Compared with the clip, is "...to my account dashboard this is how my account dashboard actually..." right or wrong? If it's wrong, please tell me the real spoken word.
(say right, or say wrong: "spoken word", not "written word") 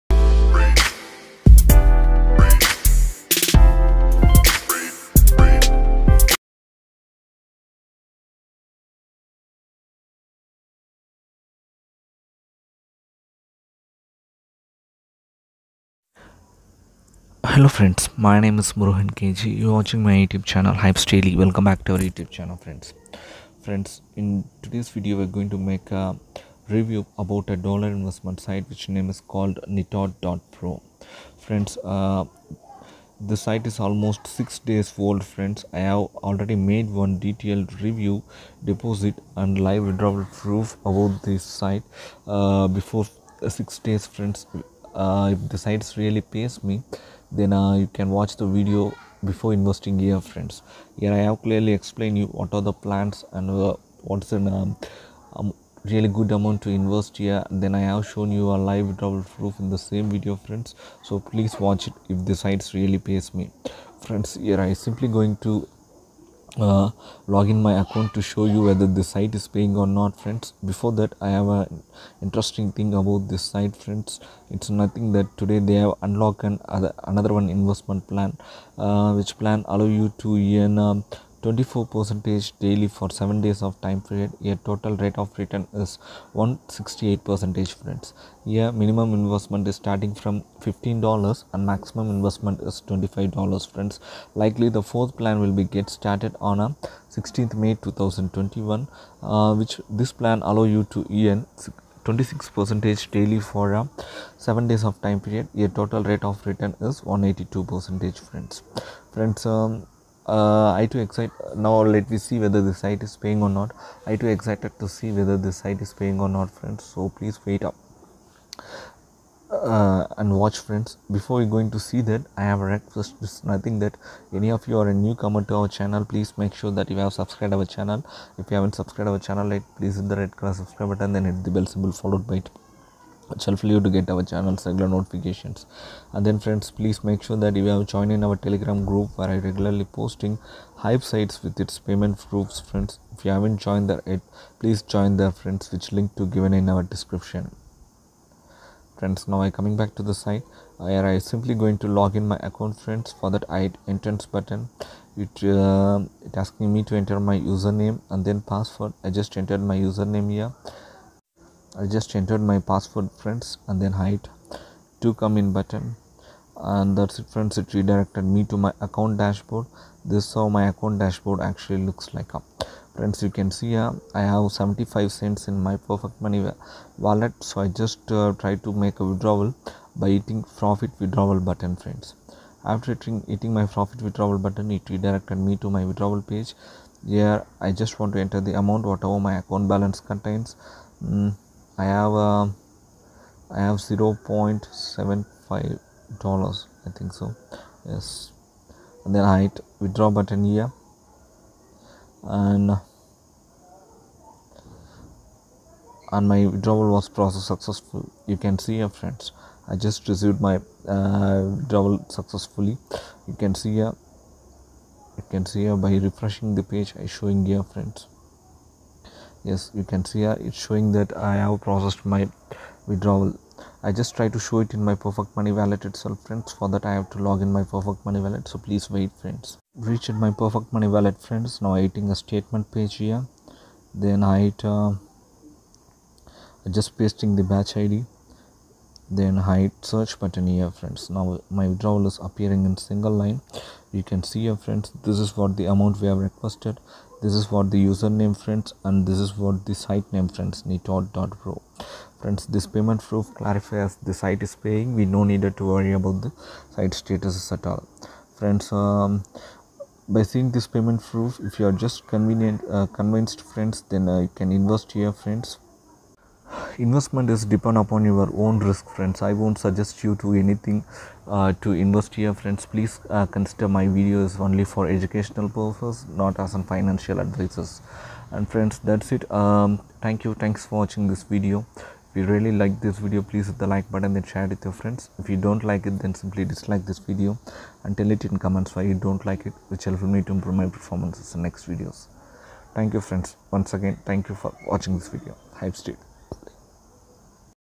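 right.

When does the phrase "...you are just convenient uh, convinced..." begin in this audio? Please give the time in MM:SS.
04:21.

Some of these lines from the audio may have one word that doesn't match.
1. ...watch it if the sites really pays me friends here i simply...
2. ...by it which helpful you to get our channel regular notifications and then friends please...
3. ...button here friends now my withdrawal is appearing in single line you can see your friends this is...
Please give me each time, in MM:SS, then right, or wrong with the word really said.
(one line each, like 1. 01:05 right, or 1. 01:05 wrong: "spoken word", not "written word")
1. 01:01 right
2. 02:12 right
3. 04:00 right.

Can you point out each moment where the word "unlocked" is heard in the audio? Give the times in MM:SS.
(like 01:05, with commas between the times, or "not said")
01:16.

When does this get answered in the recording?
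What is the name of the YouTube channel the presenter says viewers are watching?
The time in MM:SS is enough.
00:20.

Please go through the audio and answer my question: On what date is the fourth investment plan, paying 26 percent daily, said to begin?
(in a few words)
16 May 2021.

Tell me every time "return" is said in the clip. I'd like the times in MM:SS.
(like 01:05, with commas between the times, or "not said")
01:25, 01:46.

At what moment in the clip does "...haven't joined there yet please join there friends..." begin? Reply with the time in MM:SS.
02:23.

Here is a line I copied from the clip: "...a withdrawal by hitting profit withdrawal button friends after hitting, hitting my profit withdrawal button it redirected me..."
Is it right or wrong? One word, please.
right.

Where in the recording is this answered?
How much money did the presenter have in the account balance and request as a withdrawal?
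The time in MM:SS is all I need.
03:13.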